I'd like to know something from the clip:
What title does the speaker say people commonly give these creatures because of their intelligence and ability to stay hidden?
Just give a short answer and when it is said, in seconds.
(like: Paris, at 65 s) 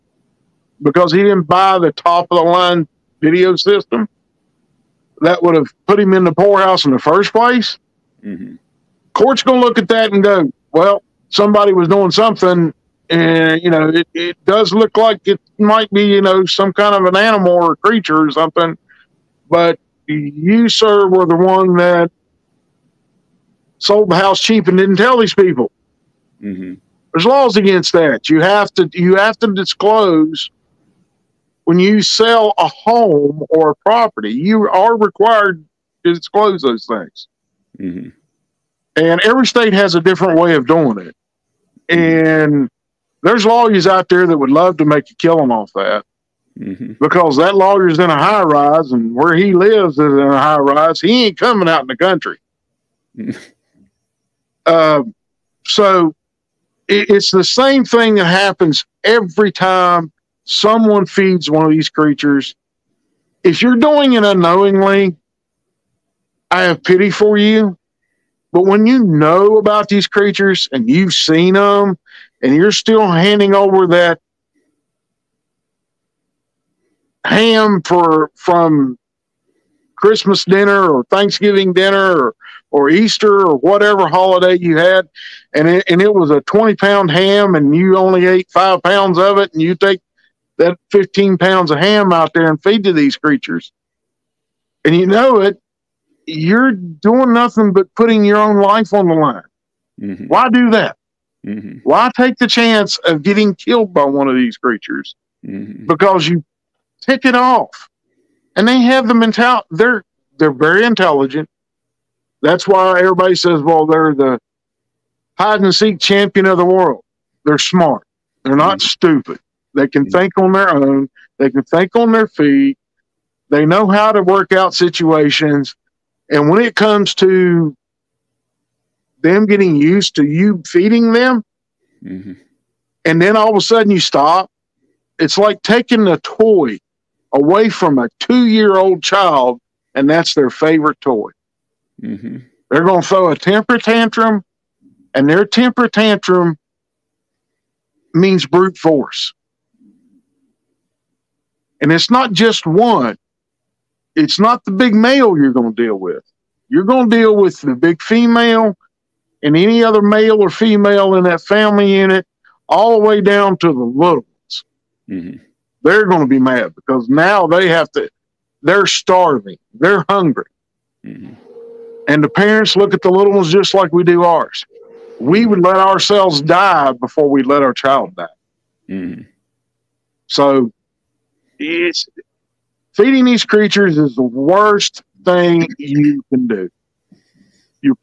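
hide and seek champion, at 115 s.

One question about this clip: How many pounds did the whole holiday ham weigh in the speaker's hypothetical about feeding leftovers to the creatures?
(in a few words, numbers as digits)
20 pounds.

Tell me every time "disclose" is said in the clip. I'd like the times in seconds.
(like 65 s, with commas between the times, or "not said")
29 s, 36 s.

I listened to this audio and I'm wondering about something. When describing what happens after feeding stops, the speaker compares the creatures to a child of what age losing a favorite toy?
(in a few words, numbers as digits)
2 years old.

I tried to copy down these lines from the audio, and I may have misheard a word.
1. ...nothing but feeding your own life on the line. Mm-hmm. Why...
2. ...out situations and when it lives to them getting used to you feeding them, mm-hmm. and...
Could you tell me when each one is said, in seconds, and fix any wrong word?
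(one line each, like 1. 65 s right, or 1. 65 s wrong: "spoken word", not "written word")
1. 97 s wrong: "putting", not "feeding"
2. 124 s wrong: "comes", not "lives".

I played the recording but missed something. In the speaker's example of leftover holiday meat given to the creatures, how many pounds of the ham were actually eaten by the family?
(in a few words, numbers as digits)
5 pounds.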